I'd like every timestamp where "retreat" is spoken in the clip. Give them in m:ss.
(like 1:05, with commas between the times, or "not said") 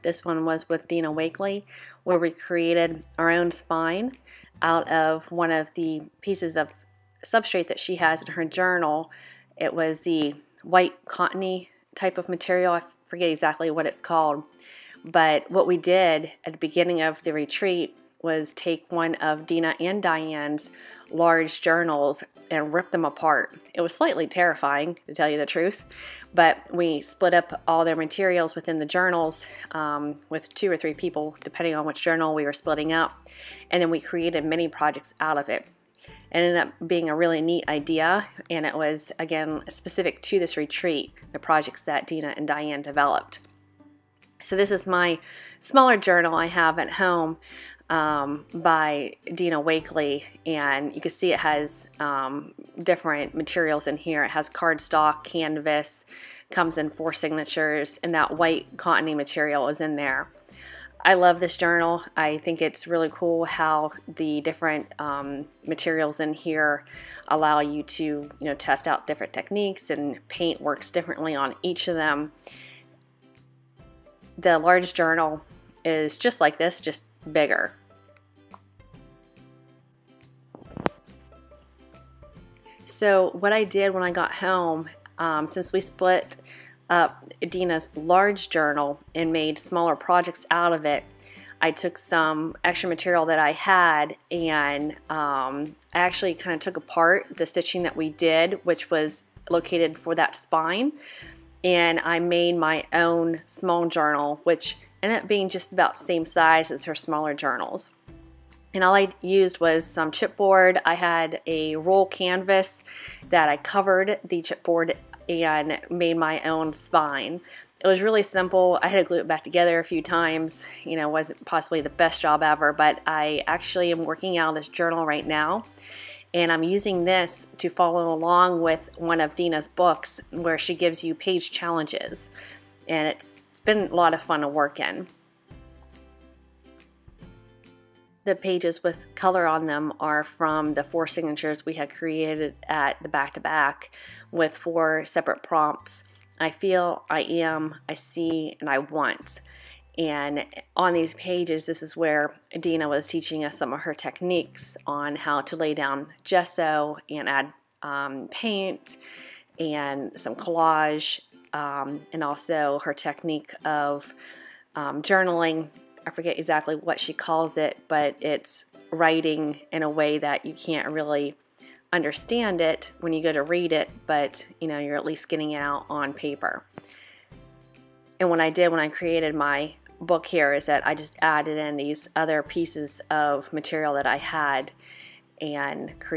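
0:17, 0:40.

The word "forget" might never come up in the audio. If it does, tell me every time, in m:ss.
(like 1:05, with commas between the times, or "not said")
0:13, 2:46.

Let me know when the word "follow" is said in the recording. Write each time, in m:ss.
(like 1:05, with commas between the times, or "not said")
2:07.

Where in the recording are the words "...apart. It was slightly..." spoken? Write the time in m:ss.
0:23.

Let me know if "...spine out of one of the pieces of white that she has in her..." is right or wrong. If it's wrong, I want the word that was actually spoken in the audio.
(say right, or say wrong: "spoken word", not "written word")
wrong: "substrate", not "white".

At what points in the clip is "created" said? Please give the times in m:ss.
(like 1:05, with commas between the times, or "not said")
0:02, 0:34, 2:21, 2:58.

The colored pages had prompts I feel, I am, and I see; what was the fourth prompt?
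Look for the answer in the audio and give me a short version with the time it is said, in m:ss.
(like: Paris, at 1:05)
I want, at 2:28.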